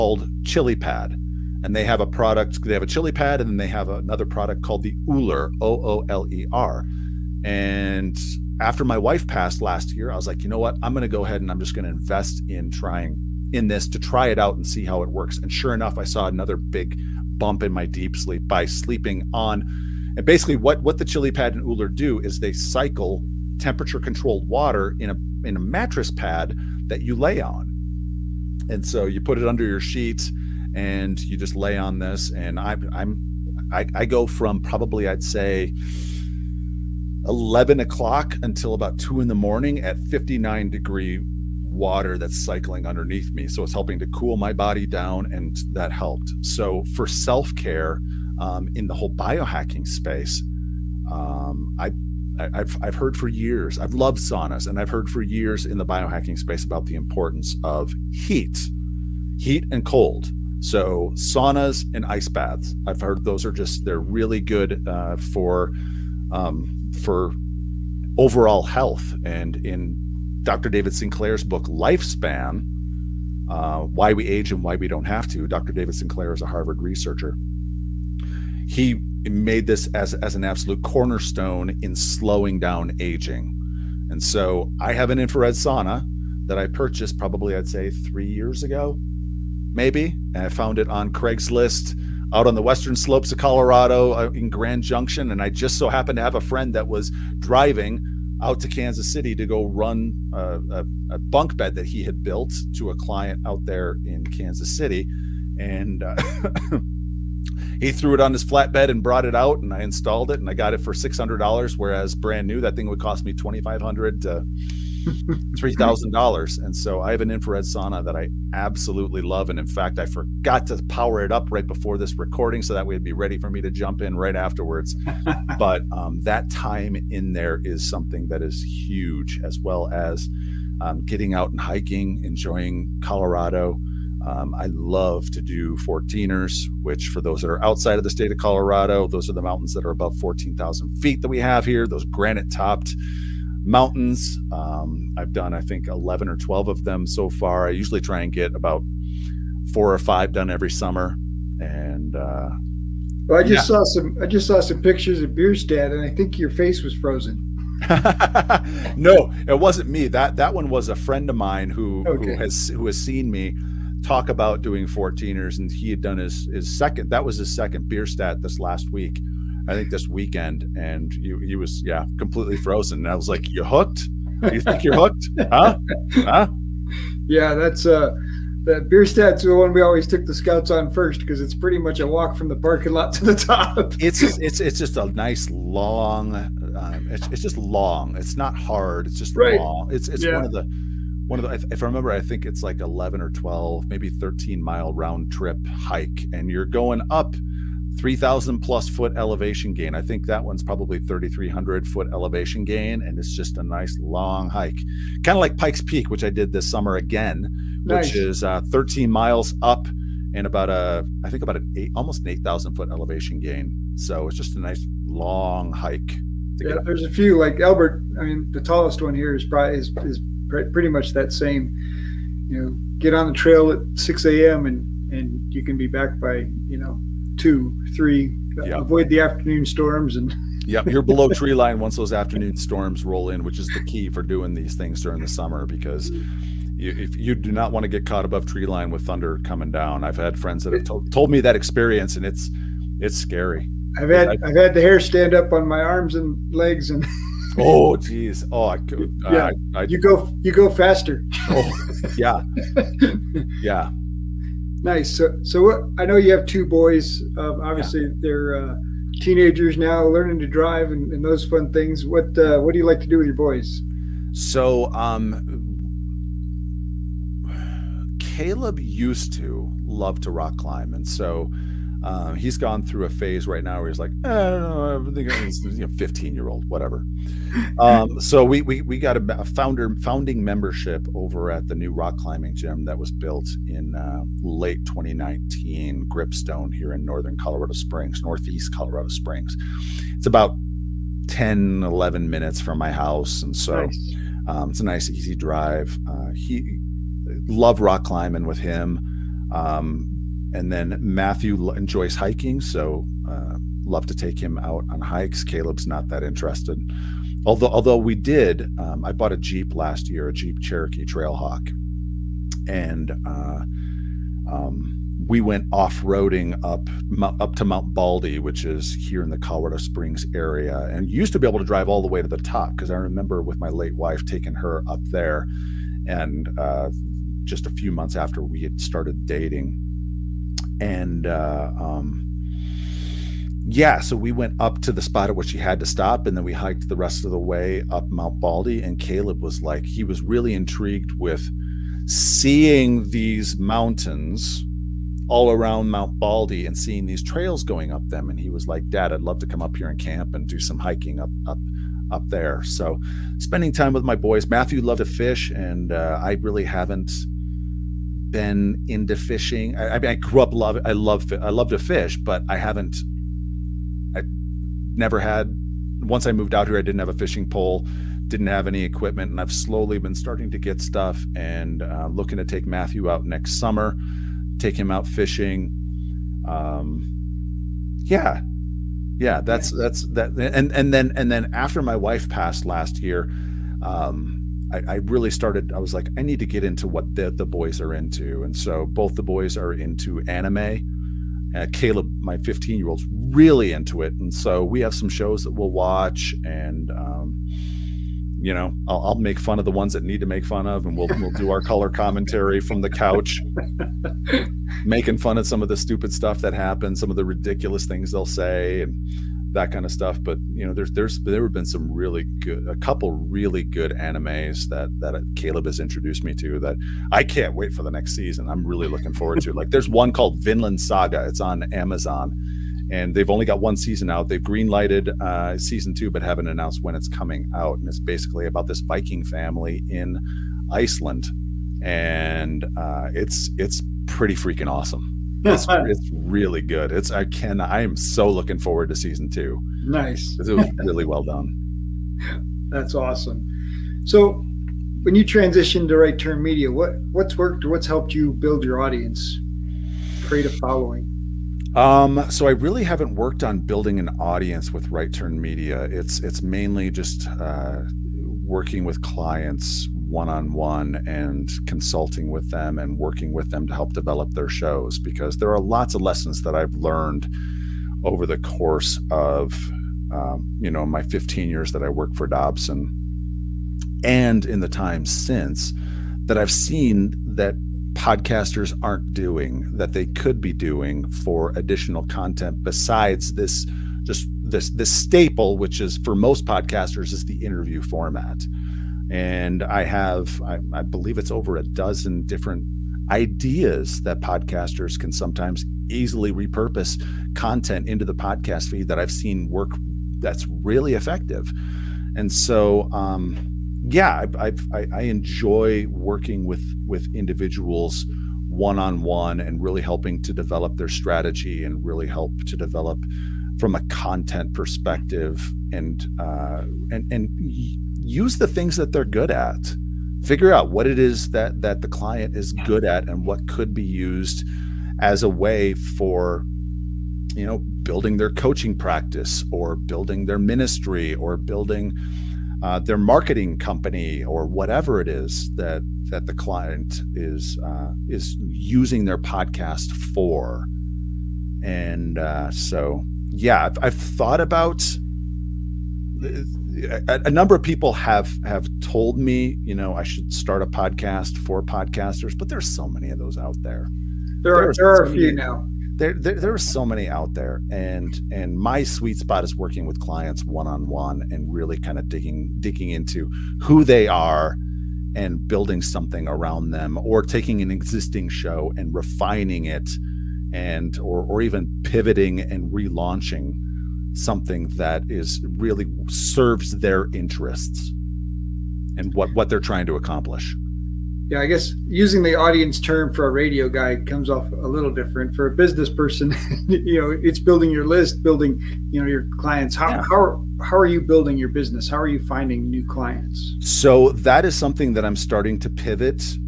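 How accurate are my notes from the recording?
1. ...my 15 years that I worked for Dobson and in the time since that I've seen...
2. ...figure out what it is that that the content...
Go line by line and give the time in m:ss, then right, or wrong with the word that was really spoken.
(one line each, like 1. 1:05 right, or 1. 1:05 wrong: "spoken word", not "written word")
1. 7:50 right
2. 8:40 wrong: "client", not "content".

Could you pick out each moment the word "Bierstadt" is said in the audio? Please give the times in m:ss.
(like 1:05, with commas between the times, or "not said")
2:35, 2:47, 2:58.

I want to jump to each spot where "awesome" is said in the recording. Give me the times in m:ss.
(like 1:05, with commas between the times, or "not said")
7:14, 7:22.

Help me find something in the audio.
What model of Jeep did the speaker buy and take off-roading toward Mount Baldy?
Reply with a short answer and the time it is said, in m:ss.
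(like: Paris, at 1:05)
Cherokee Trailhawk, at 5:10.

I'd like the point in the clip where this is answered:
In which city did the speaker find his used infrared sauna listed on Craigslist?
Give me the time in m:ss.
1:34.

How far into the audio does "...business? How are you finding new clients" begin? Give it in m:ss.
9:51.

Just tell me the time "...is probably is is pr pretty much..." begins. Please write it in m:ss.
3:39.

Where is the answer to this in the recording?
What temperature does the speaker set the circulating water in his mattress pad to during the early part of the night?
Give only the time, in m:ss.
0:40.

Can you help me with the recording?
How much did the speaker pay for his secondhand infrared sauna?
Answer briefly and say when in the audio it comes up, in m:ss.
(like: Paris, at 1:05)
$600, at 1:50.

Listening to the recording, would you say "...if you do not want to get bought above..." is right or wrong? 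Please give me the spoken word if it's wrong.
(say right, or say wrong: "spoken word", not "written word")
wrong: "caught", not "bought".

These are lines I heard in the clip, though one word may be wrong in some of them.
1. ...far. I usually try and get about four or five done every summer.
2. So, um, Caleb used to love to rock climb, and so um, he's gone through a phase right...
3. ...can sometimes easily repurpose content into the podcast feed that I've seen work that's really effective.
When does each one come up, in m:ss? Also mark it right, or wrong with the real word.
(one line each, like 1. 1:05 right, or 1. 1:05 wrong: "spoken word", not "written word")
1. 2:27 right
2. 4:24 right
3. 8:14 right.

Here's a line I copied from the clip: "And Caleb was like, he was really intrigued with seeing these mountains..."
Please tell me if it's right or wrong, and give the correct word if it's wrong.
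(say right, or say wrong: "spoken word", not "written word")
right.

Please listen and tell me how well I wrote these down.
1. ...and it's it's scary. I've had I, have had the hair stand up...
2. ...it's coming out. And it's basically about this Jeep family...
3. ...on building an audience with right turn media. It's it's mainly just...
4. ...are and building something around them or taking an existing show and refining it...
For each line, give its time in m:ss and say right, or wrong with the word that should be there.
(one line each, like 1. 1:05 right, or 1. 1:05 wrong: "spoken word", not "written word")
1. 4:02 right
2. 7:06 wrong: "Viking", not "Jeep"
3. 7:33 right
4. 9:24 right.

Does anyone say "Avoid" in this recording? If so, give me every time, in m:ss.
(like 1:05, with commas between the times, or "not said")
3:48.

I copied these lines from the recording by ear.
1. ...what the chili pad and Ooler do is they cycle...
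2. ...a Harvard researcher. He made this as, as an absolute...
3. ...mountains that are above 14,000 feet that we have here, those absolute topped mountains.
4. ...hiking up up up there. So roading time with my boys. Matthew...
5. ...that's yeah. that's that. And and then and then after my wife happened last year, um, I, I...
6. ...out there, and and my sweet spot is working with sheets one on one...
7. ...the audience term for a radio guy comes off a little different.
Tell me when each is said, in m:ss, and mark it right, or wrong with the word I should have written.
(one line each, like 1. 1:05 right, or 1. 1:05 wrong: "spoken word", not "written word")
1. 0:20 right
2. 1:16 right
3. 2:19 wrong: "granite", not "absolute"
4. 5:50 wrong: "spending", not "roading"
5. 6:19 wrong: "passed", not "happened"
6. 9:17 wrong: "clients", not "sheets"
7. 9:42 right.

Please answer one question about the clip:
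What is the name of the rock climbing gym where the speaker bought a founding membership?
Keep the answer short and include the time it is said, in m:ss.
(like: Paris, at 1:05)
Gripstone, at 4:46.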